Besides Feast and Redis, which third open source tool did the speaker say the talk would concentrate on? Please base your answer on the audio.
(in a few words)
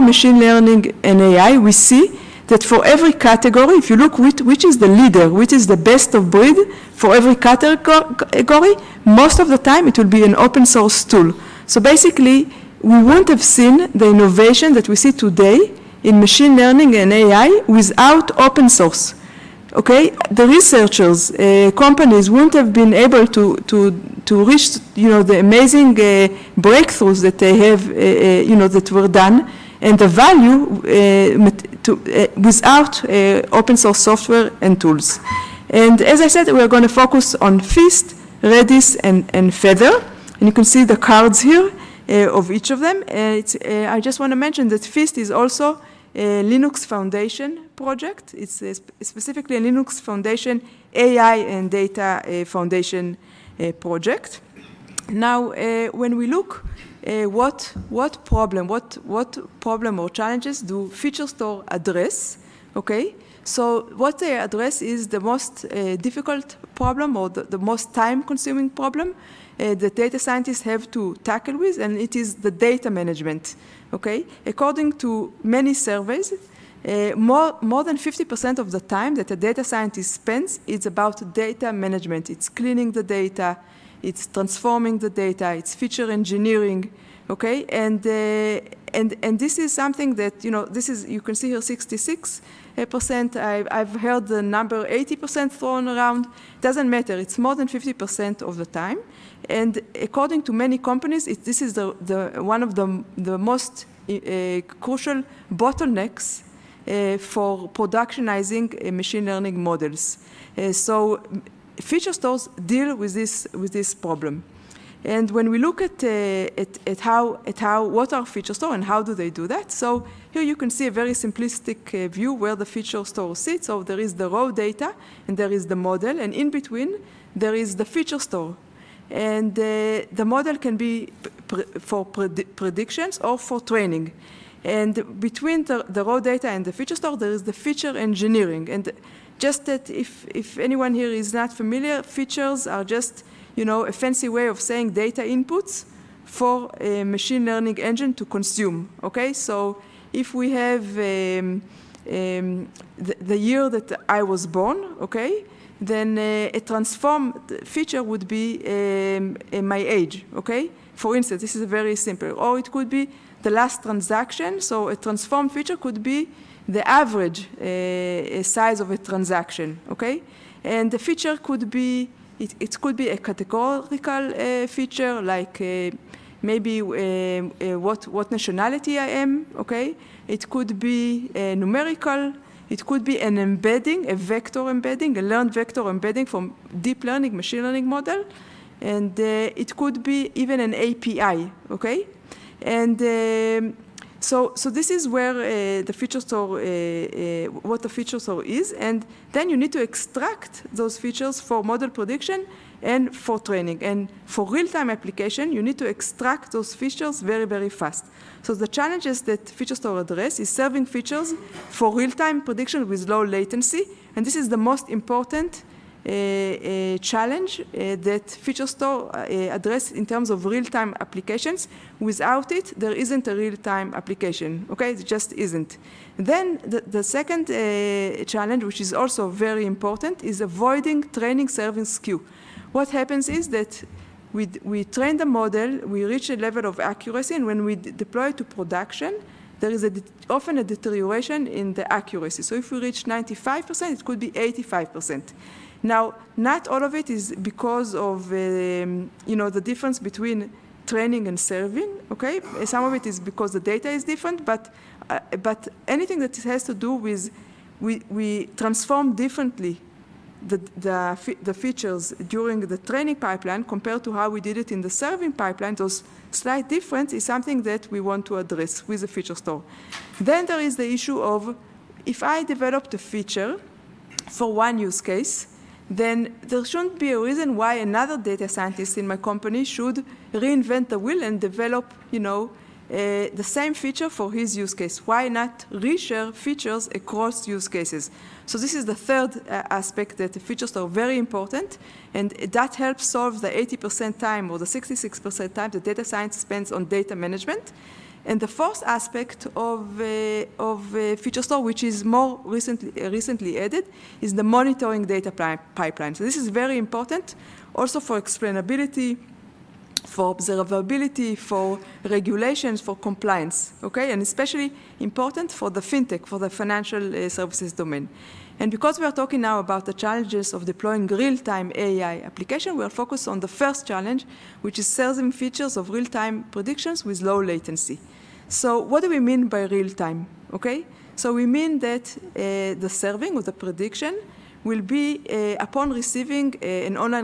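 Feathr.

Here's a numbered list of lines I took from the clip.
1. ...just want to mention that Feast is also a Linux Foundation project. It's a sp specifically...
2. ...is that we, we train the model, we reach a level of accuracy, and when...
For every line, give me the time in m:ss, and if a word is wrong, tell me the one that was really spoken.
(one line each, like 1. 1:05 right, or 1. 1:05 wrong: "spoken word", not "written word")
1. 0:43 right
2. 3:53 right.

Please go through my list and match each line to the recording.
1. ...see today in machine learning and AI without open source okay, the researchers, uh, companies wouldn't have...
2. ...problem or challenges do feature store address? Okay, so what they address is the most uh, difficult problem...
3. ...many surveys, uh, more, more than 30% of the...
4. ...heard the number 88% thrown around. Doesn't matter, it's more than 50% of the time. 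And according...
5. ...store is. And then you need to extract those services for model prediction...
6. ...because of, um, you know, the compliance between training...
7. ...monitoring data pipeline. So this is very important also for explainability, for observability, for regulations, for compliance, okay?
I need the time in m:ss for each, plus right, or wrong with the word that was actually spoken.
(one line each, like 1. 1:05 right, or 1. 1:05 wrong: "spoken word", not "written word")
1. 0:14 right
2. 0:59 right
3. 1:15 wrong: "50", not "30"
4. 1:33 wrong: "80", not "88"
5. 3:18 wrong: "features", not "services"
6. 4:07 wrong: "difference", not "compliance"
7. 5:04 right.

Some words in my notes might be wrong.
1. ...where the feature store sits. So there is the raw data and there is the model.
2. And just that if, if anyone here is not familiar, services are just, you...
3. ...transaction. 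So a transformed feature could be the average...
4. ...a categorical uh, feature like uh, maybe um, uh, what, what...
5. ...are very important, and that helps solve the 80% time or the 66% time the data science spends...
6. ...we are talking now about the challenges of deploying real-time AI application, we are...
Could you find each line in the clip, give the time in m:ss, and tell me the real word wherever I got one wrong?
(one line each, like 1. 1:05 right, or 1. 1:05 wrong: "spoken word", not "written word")
1. 2:02 right
2. 2:18 wrong: "features", not "services"
3. 2:43 right
4. 2:53 right
5. 4:50 right
6. 5:18 right.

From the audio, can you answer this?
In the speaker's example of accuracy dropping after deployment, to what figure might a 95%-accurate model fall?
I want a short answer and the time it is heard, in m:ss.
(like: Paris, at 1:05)
85%, at 4:04.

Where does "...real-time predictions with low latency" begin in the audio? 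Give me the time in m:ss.
5:25.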